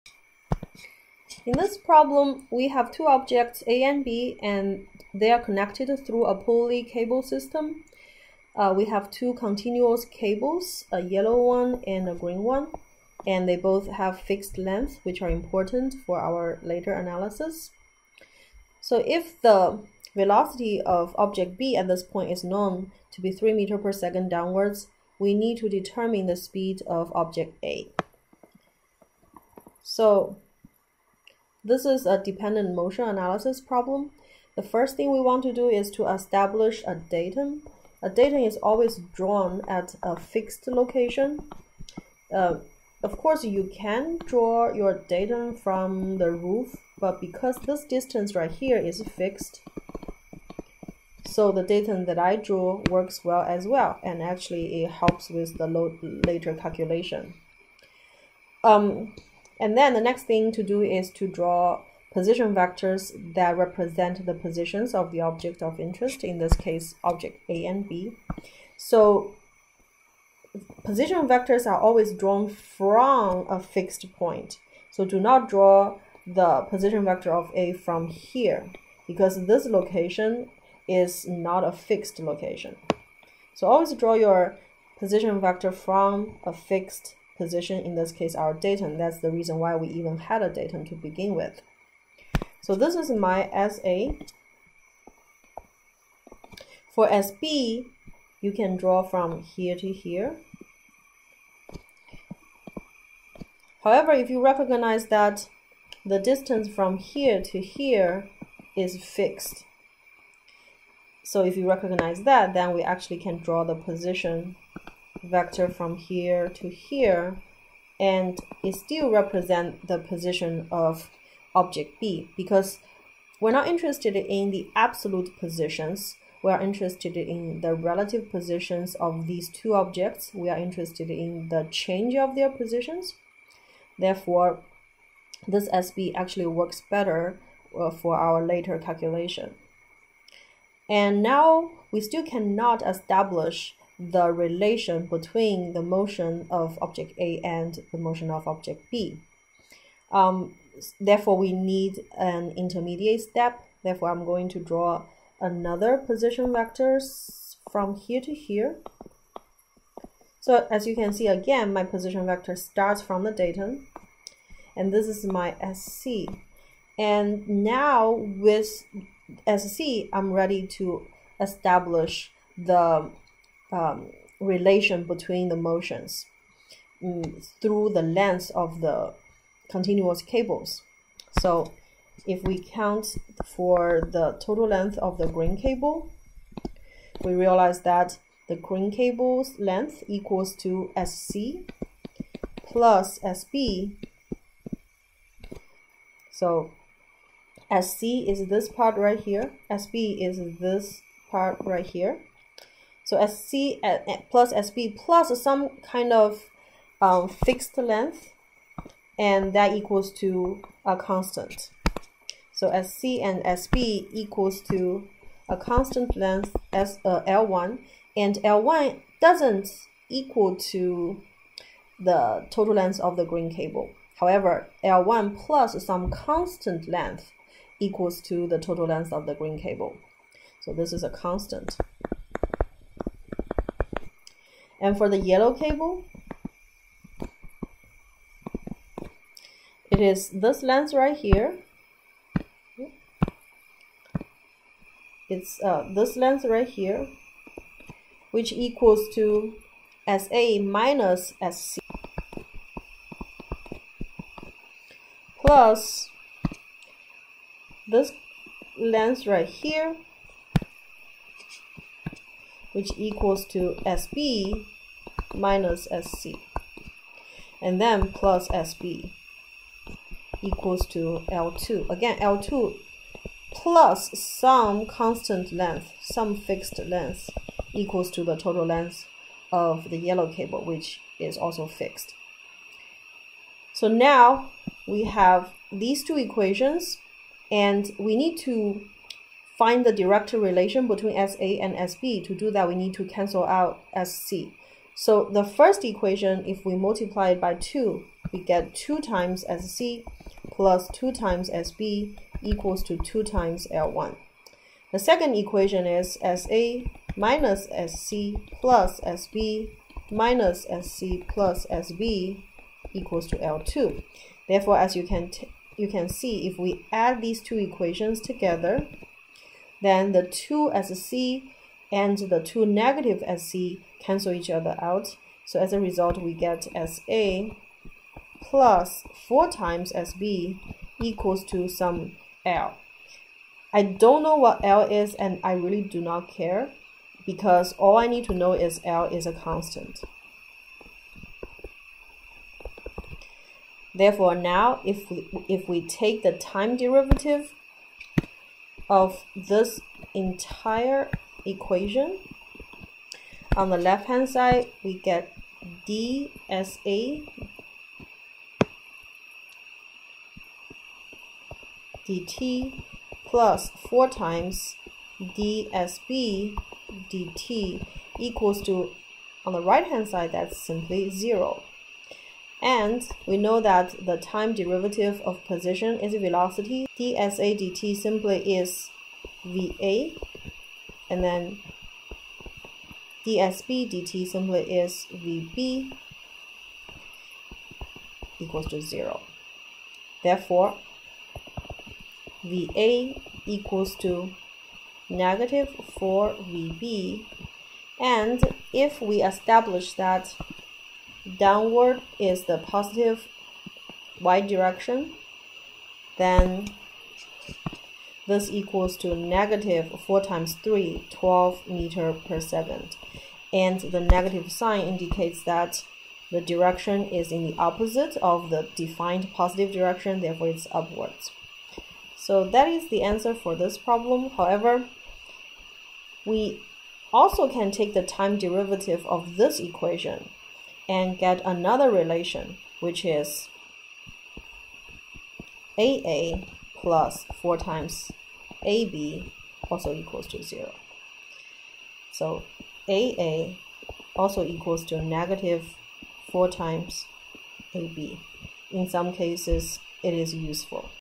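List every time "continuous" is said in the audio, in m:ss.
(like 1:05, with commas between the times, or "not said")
0:09, 2:59.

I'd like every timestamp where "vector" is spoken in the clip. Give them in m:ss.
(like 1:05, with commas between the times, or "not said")
1:02, 1:11, 1:17, 1:25, 1:55, 2:36, 2:42.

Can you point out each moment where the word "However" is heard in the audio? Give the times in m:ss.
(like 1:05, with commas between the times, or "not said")
1:43, 3:44, 7:04.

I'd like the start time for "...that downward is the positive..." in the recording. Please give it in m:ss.
6:39.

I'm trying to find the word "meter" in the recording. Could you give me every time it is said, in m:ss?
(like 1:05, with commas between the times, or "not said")
0:23, 6:51.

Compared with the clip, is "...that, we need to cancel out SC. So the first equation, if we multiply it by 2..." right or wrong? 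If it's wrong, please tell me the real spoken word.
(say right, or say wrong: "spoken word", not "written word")
right.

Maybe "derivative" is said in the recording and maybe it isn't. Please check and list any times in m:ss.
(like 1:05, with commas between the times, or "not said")
5:46, 6:14, 7:08.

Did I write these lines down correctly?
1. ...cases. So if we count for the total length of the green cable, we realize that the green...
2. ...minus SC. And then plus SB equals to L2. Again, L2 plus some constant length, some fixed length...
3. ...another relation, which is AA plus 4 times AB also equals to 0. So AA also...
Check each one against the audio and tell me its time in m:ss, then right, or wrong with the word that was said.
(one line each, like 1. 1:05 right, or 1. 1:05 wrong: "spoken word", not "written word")
1. 3:00 wrong: "cables", not "cases"
2. 4:25 right
3. 7:11 right.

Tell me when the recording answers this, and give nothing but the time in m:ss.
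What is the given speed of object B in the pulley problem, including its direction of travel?
0:23.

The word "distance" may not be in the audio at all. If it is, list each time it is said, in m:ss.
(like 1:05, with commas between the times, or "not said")
0:47, 1:46.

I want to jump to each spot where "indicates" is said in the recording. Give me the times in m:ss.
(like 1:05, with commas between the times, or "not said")
6:54.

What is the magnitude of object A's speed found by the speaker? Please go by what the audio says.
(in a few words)
12 m/s.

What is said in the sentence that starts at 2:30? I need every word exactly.
Um, therefore, we need an intermediate step.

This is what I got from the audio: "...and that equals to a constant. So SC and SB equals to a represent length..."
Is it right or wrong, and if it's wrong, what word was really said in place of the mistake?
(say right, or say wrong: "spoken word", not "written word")
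wrong: "constant", not "represent".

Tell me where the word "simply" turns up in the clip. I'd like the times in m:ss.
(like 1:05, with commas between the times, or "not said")
6:10, 6:17, 6:24.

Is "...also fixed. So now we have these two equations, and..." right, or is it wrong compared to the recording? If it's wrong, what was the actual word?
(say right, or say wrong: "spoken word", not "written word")
right.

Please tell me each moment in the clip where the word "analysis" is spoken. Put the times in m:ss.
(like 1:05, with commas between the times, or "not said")
0:16, 0:33.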